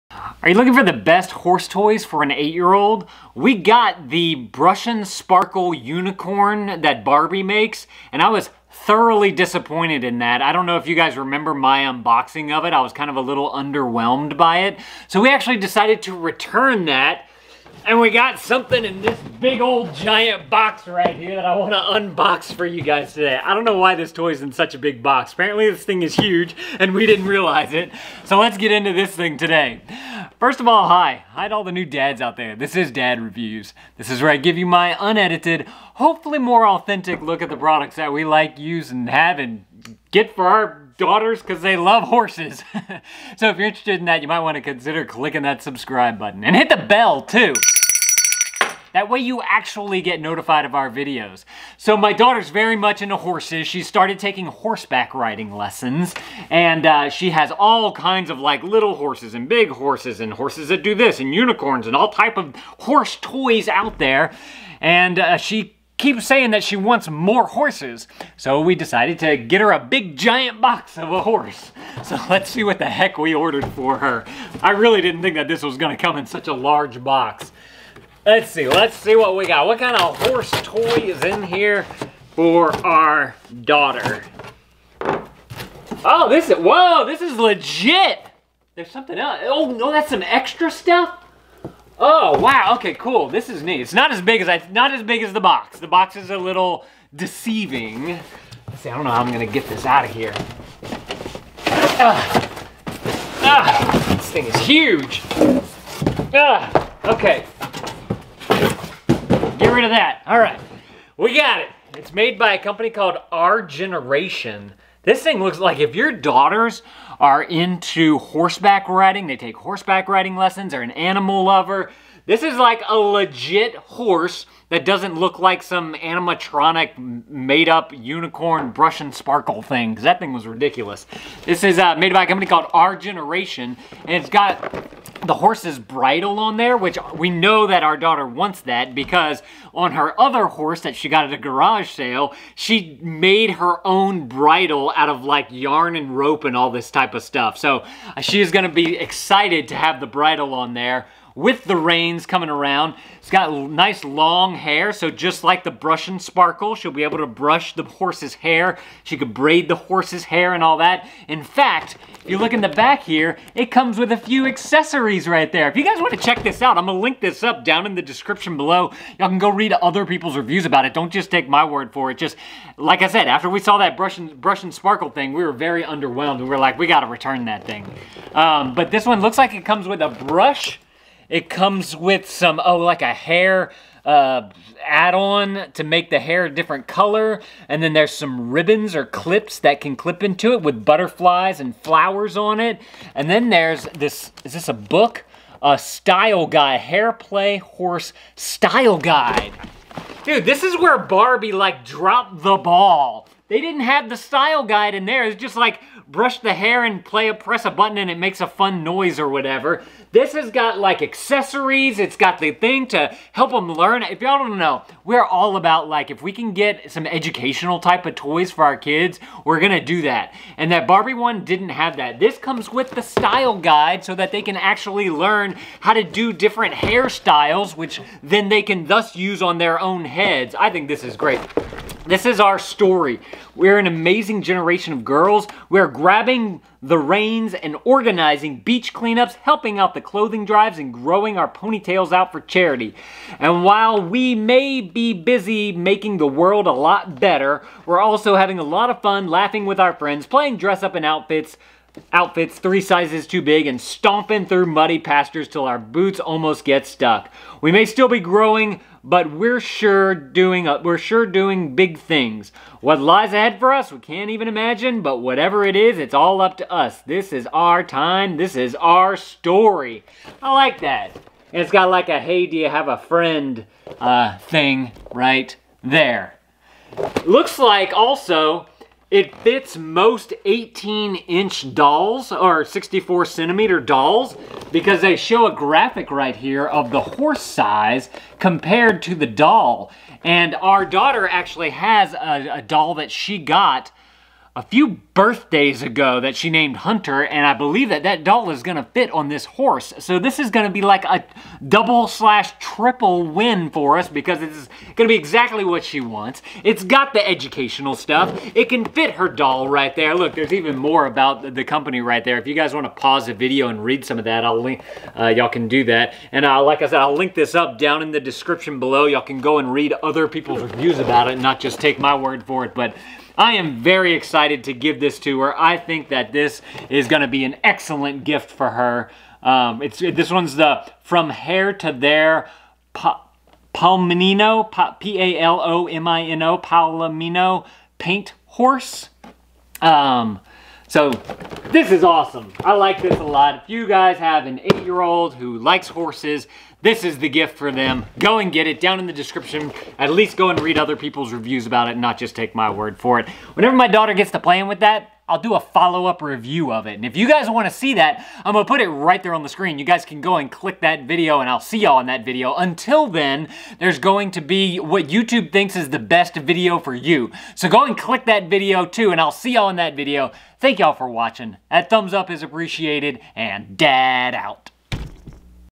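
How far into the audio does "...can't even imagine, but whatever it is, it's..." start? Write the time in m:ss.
4:23.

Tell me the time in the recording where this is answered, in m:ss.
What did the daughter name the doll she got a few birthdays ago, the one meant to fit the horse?
4:56.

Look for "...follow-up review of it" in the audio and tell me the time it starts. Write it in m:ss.
5:55.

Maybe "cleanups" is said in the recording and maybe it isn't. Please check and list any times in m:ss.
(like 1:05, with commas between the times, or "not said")
3:58.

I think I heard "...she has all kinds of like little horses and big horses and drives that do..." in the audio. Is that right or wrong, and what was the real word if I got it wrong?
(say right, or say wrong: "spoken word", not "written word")
wrong: "horses", not "drives".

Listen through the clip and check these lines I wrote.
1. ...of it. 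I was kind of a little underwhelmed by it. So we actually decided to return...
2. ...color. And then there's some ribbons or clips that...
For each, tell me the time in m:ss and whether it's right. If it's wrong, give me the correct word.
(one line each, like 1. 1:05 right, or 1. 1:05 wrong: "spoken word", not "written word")
1. 0:12 right
2. 3:06 right.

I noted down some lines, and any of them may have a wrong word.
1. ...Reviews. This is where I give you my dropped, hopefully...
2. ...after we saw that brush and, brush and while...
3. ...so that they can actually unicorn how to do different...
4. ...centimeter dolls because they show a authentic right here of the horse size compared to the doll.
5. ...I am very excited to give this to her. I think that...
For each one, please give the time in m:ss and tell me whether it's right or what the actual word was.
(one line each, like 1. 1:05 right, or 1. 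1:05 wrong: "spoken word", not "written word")
1. 0:33 wrong: "unedited", not "dropped"
2. 2:53 wrong: "sparkle", not "while"
3. 3:44 wrong: "learn", not "unicorn"
4. 4:43 wrong: "graphic", not "authentic"
5. 5:23 right.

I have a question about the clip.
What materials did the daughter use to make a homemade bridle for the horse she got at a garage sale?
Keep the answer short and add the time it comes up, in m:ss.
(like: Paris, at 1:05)
yarn and rope, at 2:25.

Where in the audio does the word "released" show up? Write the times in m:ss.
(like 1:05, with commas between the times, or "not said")
not said.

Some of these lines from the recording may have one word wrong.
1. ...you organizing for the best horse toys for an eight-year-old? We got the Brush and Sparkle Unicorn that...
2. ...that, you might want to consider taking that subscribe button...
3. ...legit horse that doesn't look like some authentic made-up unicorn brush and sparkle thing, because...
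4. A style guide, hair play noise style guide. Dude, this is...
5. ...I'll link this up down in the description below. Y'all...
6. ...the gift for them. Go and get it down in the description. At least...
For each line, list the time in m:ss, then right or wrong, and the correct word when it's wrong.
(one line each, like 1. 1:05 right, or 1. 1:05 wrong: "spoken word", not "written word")
1. 0:00 wrong: "looking", not "organizing"
2. 0:44 wrong: "clicking", not "taking"
3. 2:02 wrong: "animatronic", not "authentic"
4. 3:15 wrong: "horse", not "noise"
5. 5:16 right
6. 5:47 right.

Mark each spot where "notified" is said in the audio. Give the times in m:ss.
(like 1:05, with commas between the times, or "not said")
0:50.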